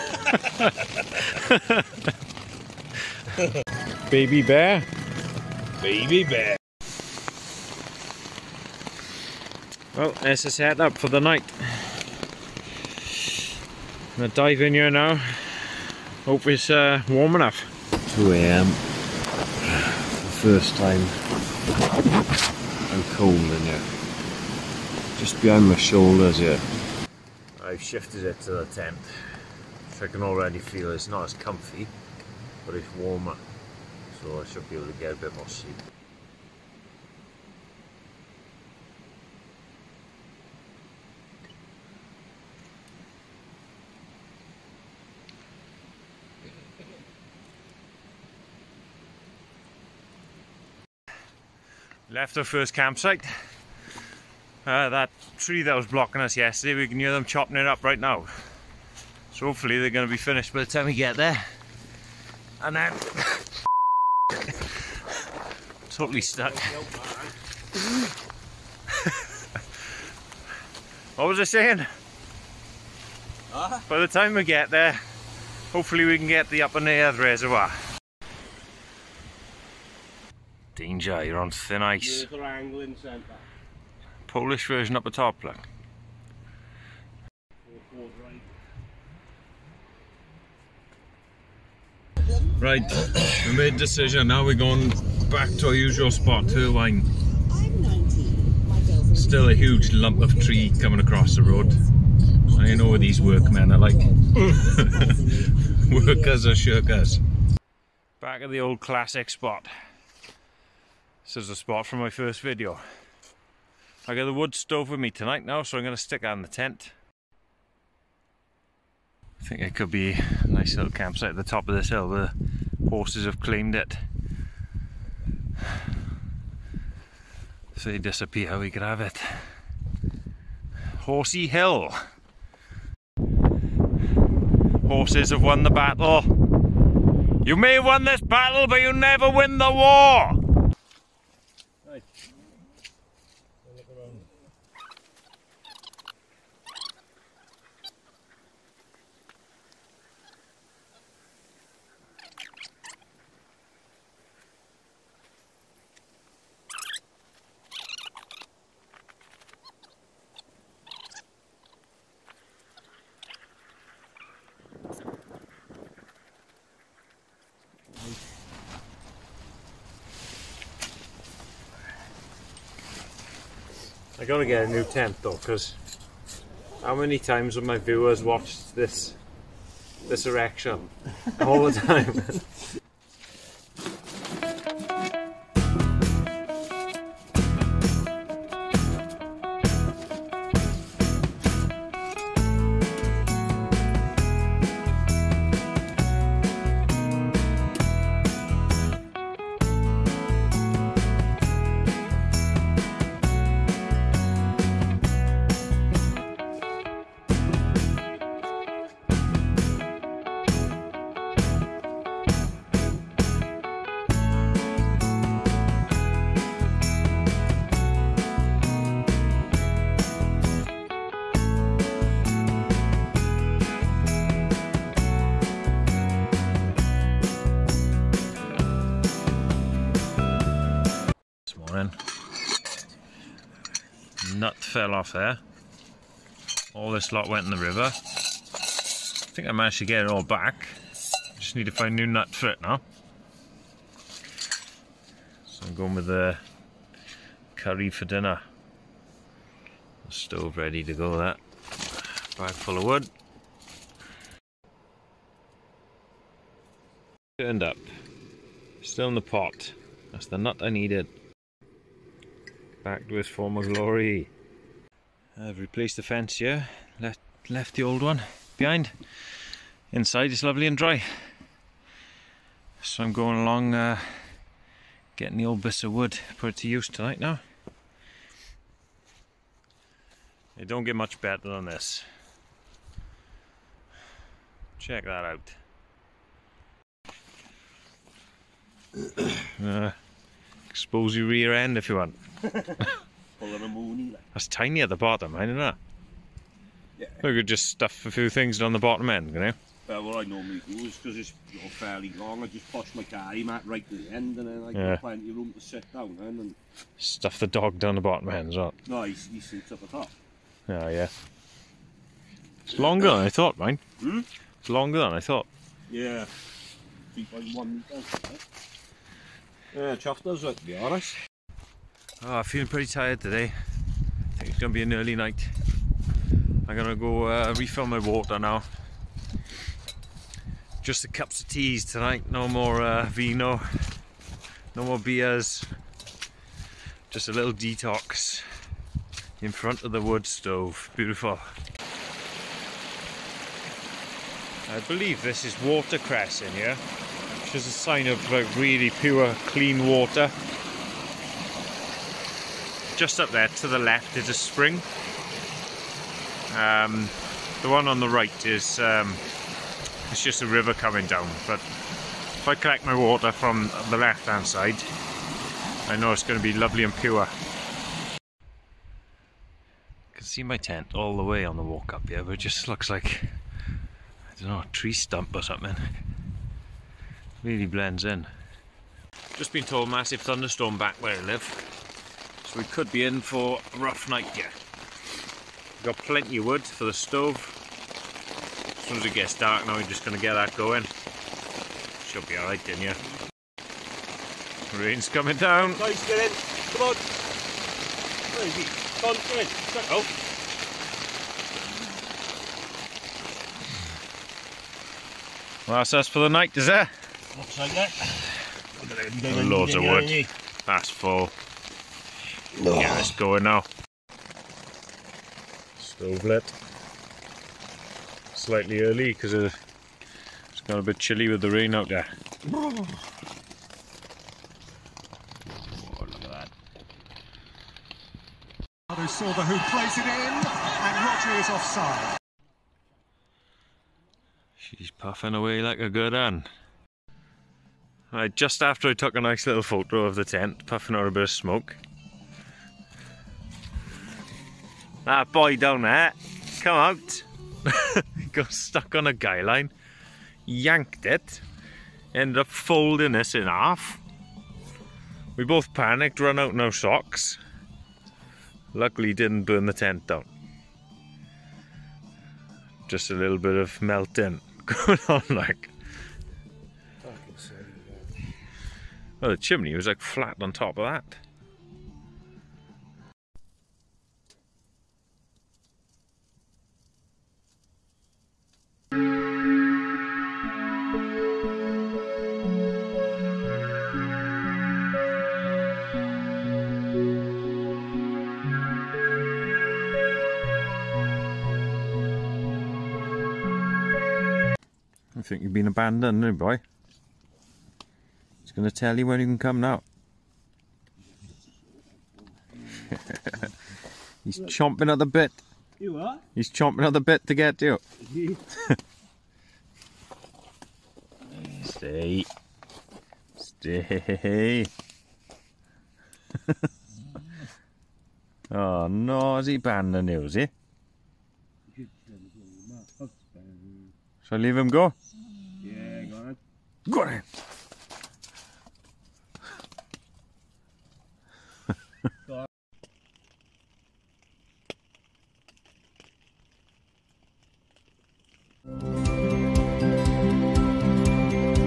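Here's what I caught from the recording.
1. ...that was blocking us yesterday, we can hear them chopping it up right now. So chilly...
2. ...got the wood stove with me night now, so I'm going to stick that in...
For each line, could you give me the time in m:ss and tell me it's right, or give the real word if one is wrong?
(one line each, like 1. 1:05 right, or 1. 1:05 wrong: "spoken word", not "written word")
1. 0:55 wrong: "hopefully", not "chilly"
2. 1:54 wrong: "tonight", not "night".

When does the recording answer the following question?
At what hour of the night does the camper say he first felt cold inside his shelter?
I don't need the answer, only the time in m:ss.
0:18.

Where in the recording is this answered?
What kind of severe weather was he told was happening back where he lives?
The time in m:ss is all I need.
6:19.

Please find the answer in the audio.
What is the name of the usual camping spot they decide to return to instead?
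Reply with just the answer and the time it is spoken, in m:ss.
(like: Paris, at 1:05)
Hirwaun, at 1:36.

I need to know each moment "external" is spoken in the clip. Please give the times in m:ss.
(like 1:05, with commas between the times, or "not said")
not said.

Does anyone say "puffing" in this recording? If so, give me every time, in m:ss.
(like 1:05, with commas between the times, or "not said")
7:14, 7:20.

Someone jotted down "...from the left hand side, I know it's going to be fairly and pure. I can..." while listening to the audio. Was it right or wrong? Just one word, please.
wrong.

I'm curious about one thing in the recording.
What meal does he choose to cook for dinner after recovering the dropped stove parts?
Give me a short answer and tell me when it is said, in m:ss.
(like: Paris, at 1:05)
Curry, at 4:06.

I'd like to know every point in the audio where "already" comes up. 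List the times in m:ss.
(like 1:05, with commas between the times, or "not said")
0:30.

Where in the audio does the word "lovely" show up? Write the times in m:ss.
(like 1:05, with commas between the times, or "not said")
4:30, 6:06.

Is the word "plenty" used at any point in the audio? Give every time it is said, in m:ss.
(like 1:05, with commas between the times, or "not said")
5:05, 6:25.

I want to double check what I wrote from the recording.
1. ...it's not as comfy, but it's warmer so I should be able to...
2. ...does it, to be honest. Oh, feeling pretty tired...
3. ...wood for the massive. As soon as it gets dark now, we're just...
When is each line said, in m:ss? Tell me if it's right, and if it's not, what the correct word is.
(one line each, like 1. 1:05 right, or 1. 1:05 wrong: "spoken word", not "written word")
1. 0:30 right
2. 5:20 right
3. 6:26 wrong: "stove", not "massive".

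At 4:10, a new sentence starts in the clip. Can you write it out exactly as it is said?
The stove ready to go that.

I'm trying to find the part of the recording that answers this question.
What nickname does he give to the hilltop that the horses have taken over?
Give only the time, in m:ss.
2:11.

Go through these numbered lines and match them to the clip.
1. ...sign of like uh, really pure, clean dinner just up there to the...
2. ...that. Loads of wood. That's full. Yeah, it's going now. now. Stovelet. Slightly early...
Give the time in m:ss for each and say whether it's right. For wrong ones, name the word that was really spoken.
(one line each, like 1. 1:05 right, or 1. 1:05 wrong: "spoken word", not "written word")
1. 5:47 wrong: "water", not "dinner"
2. 6:47 right.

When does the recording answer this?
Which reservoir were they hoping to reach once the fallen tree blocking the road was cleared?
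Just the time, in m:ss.
1:16.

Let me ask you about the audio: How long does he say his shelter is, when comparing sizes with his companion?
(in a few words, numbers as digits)
3.1 metres.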